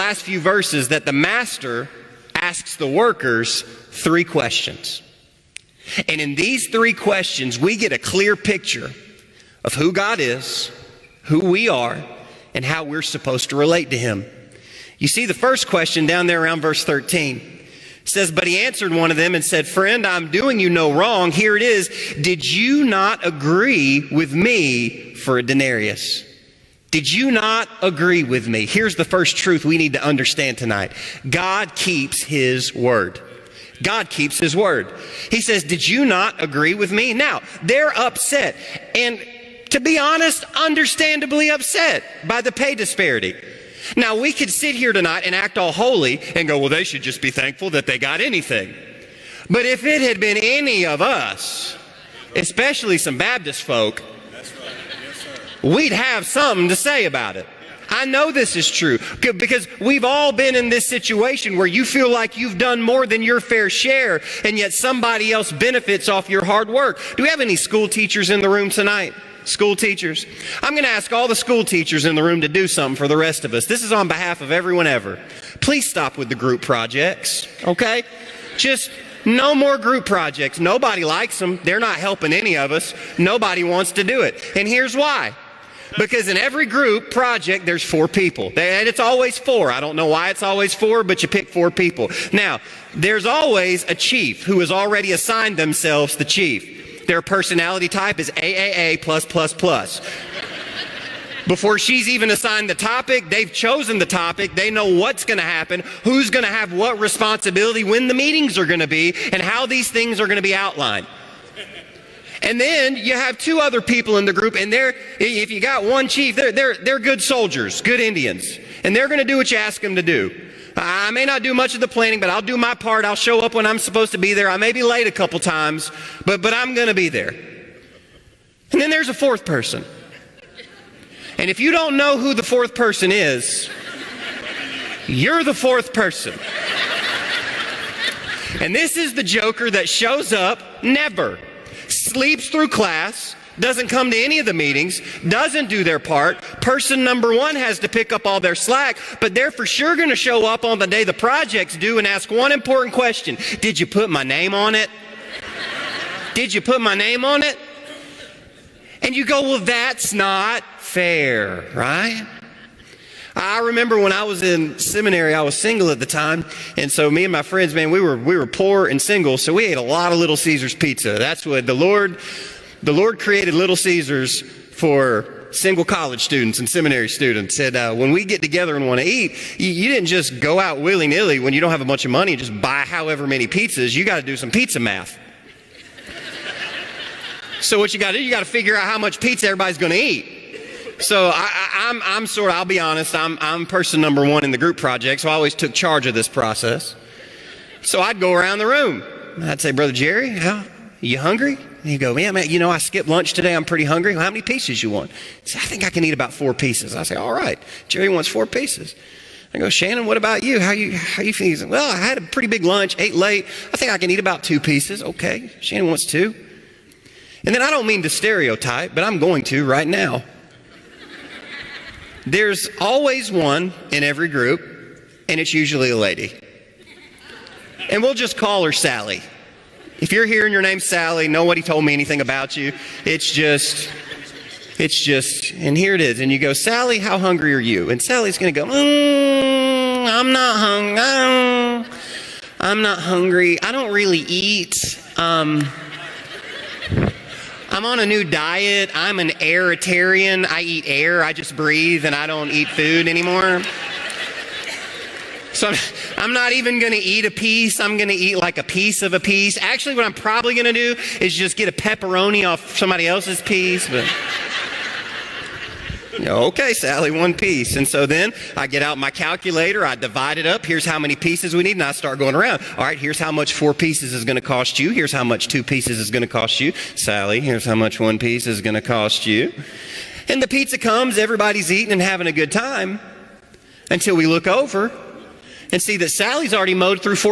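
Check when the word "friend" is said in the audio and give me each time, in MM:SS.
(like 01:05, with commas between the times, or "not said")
00:19, 02:47.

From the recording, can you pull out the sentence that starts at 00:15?
You see the first question down there around verse 13.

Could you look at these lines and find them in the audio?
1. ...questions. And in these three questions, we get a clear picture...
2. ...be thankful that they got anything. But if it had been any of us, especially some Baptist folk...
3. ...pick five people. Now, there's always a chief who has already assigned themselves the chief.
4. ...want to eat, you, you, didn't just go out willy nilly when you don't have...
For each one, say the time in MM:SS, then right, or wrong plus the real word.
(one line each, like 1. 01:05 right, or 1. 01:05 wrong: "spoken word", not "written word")
1. 00:04 right
2. 00:47 right
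3. 01:31 wrong: "four", not "five"
4. 02:58 right.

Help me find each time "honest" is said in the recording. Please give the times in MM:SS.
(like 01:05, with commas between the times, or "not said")
00:39, 03:12.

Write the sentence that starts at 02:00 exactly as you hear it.
I may not do much of the planning, but I'll do my part.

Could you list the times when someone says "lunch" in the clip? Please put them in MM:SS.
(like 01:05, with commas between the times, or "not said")
03:23, 03:32.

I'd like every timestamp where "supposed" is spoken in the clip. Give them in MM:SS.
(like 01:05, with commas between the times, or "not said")
00:13, 02:03.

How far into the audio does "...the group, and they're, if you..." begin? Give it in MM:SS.
01:54.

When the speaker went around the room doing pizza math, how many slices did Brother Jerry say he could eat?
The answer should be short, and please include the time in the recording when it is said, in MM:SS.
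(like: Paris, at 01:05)
4, at 03:26.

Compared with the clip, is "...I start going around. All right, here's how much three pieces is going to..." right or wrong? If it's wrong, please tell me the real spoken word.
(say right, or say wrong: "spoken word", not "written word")
wrong: "four", not "three".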